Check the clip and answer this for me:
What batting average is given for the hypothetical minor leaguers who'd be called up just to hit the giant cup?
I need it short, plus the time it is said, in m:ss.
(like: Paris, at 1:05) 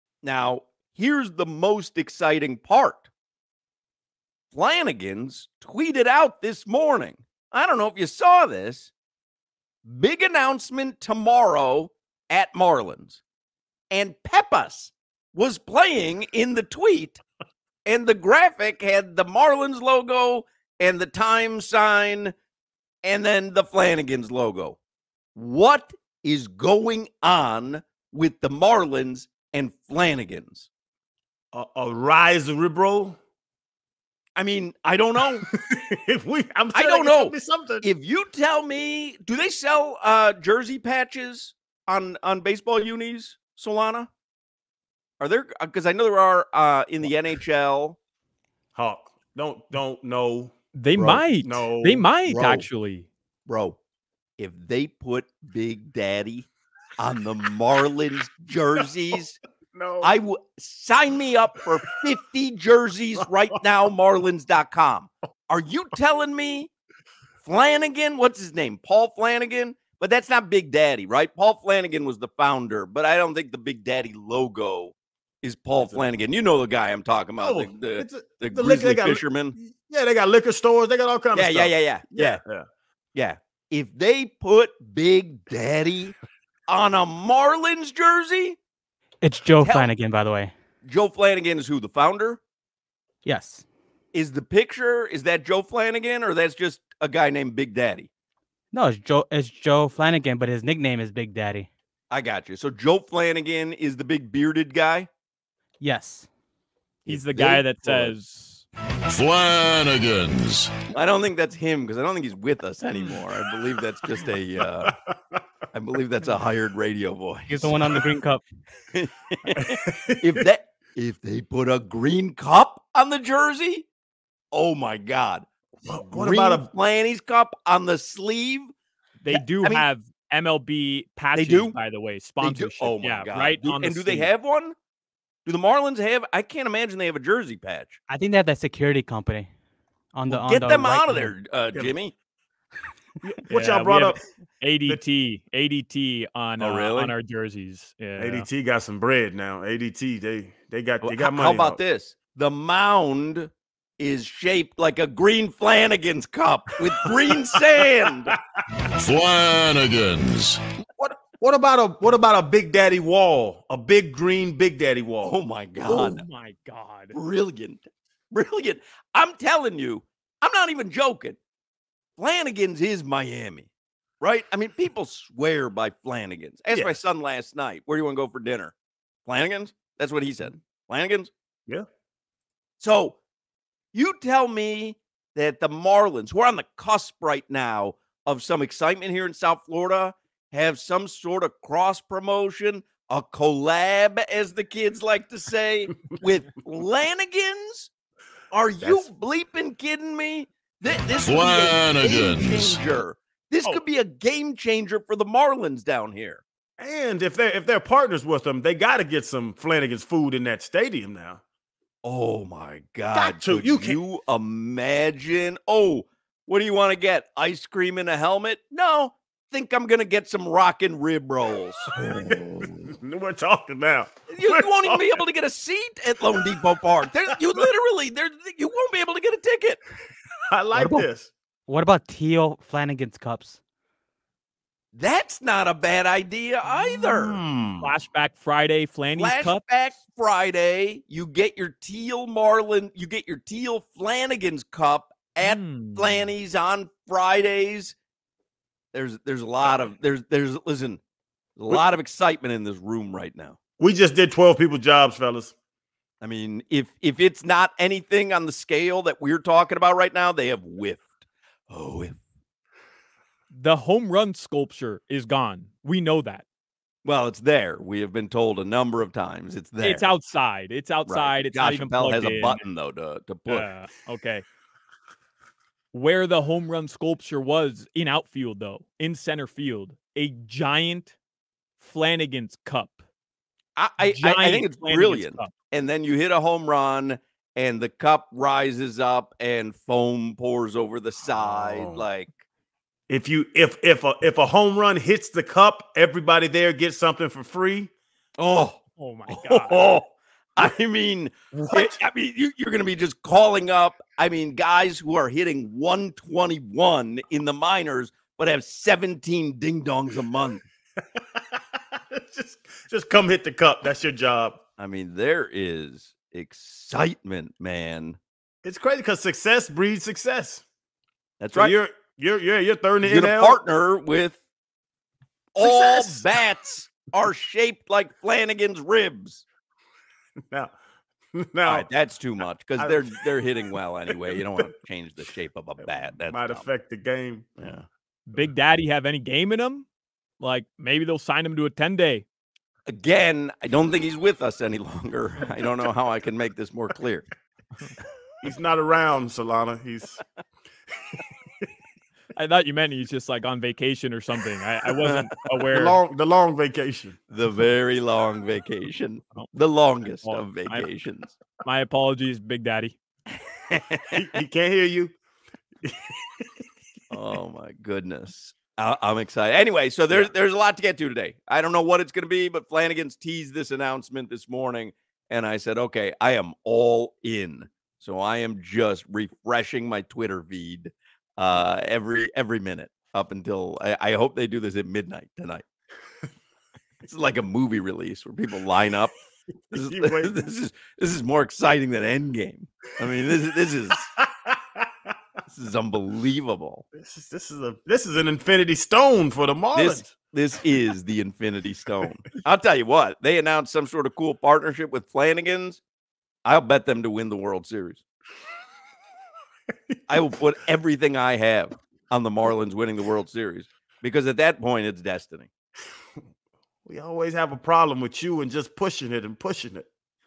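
.121, at 5:05.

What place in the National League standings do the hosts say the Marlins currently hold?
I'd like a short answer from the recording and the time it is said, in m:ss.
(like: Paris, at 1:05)
Third, at 5:22.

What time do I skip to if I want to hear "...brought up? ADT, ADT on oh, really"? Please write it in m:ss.
2:23.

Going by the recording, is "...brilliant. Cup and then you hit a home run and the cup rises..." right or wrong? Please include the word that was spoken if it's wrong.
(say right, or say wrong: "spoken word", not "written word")
right.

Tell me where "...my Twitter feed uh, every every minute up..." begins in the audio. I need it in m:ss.
6:19.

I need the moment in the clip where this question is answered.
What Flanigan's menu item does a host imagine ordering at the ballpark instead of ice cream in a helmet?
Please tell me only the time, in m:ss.
3:40.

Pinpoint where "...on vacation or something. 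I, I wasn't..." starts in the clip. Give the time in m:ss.
5:53.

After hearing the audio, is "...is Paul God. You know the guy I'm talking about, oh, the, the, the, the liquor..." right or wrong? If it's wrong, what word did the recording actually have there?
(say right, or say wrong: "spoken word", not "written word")
wrong: "Flanigan", not "God".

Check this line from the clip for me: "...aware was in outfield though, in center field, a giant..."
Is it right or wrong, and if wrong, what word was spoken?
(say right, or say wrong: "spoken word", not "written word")
wrong: "sculpture", not "aware".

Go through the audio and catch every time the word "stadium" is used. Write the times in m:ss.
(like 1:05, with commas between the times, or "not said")
3:30.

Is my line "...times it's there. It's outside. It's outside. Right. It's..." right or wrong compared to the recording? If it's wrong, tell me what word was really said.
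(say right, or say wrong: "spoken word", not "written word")
right.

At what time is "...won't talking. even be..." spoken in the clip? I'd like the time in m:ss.
3:44.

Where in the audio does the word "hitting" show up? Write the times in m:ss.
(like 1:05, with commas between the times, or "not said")
5:05, 5:33.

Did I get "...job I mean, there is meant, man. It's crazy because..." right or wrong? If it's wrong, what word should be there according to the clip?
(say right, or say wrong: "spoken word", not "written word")
wrong: "excitement", not "meant".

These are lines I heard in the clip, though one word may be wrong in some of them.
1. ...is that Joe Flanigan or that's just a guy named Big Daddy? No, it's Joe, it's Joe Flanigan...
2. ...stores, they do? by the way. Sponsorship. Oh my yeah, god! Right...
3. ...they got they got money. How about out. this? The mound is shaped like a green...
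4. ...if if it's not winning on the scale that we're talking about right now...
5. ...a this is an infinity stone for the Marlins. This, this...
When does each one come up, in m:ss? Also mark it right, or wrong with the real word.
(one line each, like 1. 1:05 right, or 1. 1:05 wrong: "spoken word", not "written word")
1. 1:35 right
2. 2:11 wrong: "patches", not "stores"
3. 2:30 right
4. 4:16 wrong: "anything", not "winning"
5. 6:37 right.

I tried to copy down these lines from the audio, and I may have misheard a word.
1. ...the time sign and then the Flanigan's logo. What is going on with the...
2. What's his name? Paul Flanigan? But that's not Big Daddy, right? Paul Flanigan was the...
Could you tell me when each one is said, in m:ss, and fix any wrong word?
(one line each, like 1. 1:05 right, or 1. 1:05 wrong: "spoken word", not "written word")
1. 0:20 right
2. 1:08 right.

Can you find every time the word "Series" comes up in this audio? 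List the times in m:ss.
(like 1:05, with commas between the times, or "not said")
6:47, 6:53.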